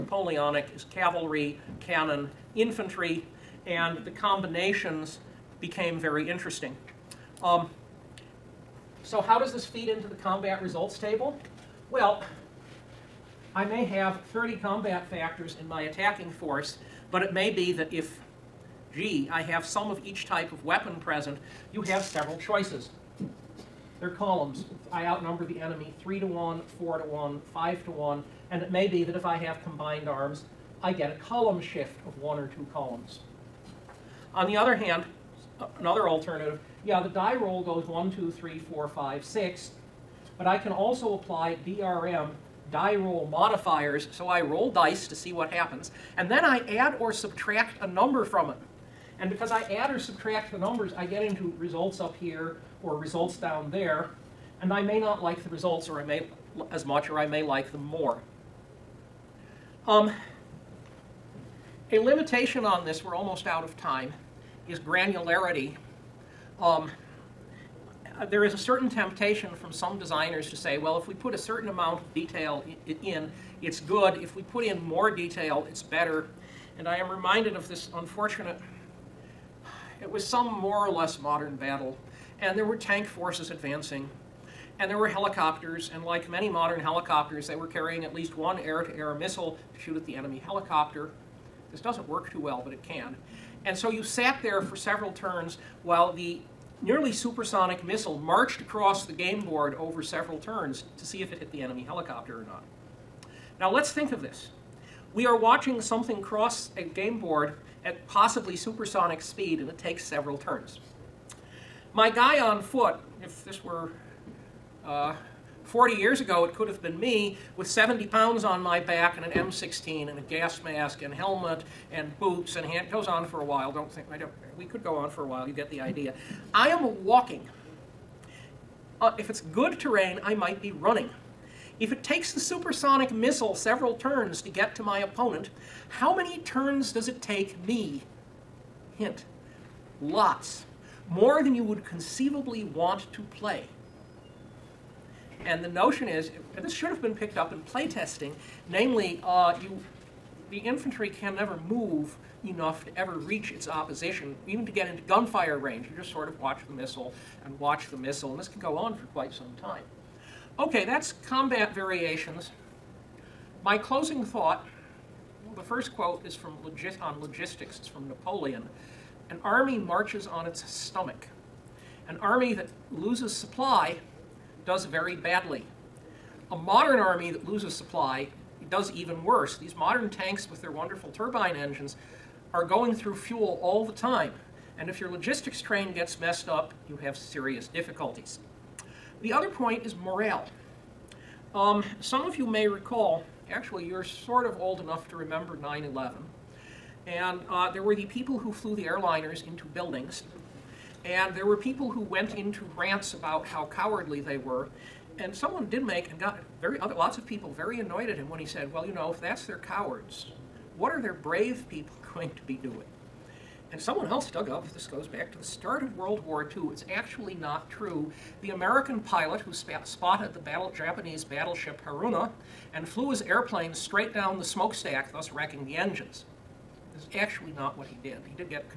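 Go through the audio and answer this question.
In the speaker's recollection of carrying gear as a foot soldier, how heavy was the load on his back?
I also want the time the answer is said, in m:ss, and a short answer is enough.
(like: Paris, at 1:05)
70 pounds, at 1:57.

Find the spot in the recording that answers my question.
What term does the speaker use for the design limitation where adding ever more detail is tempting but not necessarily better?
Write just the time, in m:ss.
1:04.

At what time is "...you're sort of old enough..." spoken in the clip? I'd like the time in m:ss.
3:13.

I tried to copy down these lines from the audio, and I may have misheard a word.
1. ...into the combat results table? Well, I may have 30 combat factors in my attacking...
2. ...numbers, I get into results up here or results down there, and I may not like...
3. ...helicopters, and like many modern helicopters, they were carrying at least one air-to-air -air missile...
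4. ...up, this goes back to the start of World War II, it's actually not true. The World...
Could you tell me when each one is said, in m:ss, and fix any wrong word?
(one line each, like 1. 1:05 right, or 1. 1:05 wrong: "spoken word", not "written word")
1. 0:09 right
2. 0:50 right
3. 1:25 right
4. 3:34 wrong: "American", not "World".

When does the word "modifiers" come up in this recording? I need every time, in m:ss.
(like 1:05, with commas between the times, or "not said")
0:43.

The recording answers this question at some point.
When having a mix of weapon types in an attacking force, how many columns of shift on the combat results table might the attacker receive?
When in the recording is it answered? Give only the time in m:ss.
0:32.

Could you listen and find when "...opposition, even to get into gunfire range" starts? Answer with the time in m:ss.
2:33.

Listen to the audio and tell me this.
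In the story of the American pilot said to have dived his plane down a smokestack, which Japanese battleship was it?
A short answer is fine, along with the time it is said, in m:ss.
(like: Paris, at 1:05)
Haruna, at 3:41.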